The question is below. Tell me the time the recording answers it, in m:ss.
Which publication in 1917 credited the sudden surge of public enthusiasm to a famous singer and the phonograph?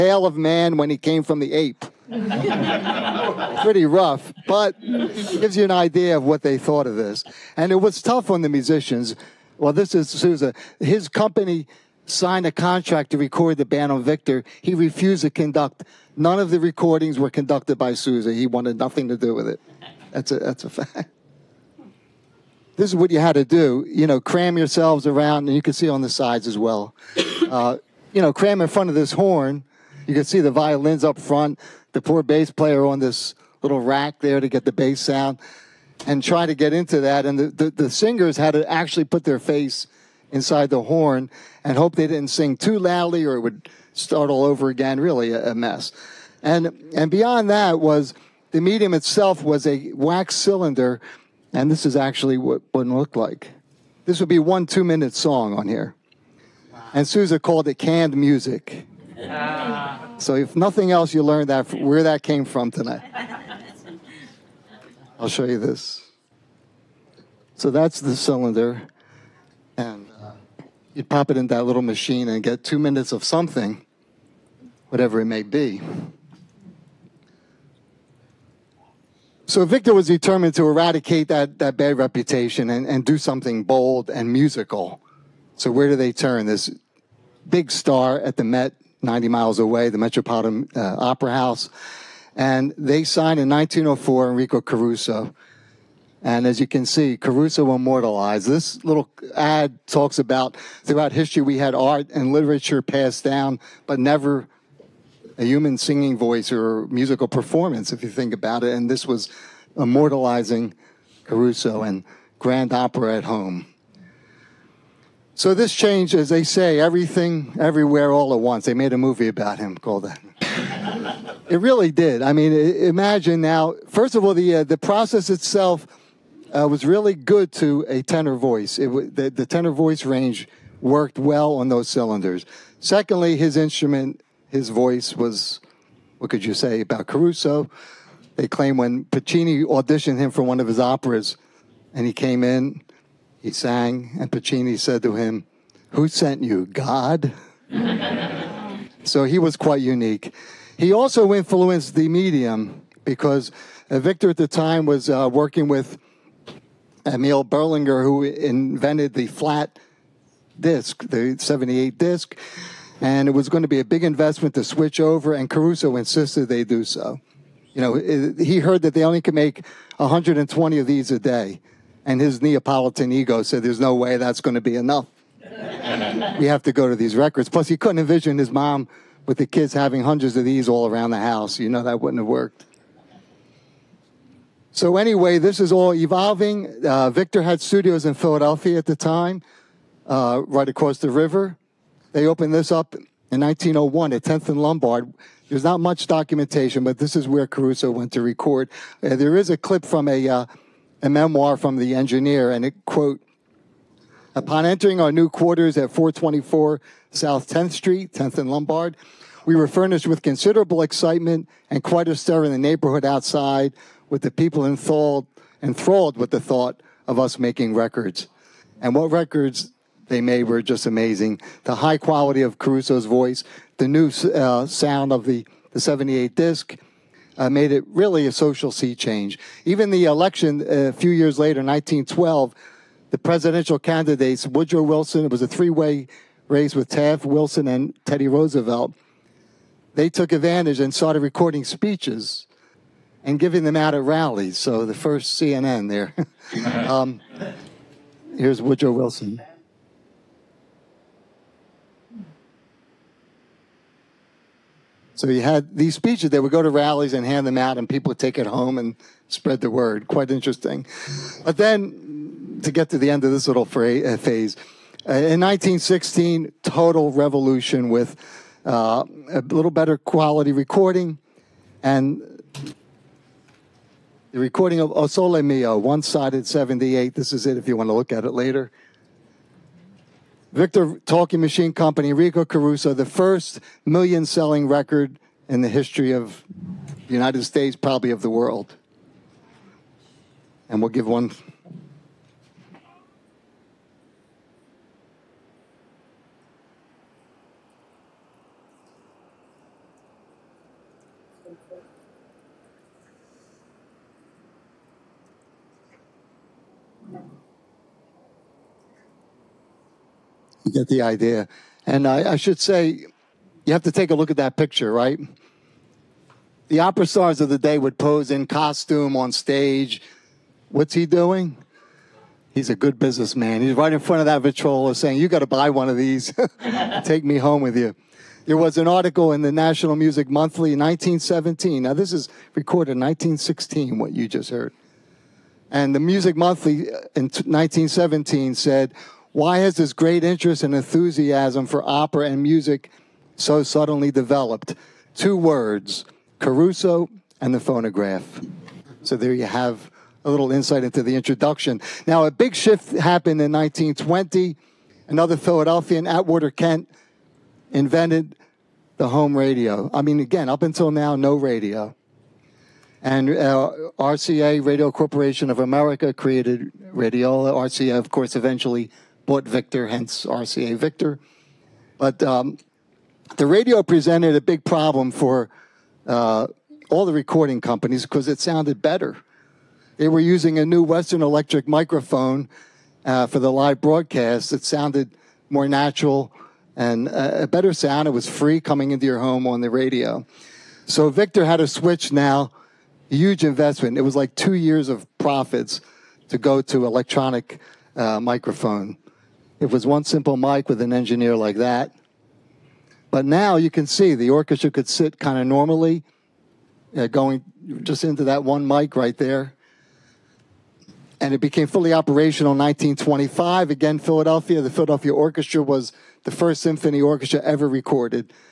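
5:29.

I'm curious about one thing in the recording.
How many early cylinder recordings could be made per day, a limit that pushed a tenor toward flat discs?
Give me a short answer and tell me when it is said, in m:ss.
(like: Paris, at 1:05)
120, at 2:49.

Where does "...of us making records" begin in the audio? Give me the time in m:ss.
3:37.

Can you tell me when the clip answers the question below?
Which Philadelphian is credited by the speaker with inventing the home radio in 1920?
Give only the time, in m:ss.
5:56.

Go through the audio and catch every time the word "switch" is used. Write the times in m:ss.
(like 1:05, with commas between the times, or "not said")
2:44, 6:31.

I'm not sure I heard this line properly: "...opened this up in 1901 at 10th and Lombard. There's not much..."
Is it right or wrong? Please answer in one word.
right.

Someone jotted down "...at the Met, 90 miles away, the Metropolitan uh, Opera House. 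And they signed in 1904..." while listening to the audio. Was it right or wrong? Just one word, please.
right.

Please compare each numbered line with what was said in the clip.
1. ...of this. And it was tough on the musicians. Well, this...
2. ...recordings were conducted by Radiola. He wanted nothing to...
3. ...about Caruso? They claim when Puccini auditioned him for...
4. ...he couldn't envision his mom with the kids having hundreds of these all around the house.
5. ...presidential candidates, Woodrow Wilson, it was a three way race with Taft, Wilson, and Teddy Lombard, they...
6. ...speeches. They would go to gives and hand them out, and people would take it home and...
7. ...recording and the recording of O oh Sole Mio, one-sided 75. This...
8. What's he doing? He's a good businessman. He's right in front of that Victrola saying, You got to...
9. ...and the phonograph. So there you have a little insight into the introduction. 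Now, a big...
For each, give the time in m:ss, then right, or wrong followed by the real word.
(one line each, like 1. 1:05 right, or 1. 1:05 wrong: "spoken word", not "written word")
1. 0:06 right
2. 0:16 wrong: "Sousa", not "Radiola"
3. 2:16 right
4. 2:57 right
5. 3:53 wrong: "Roosevelt", not "Lombard"
6. 4:15 wrong: "rallies", not "gives"
7. 4:30 wrong: "78", not "75"
8. 5:20 right
9. 5:47 right.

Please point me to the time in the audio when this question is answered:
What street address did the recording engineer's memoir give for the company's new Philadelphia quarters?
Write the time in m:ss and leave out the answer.
3:25.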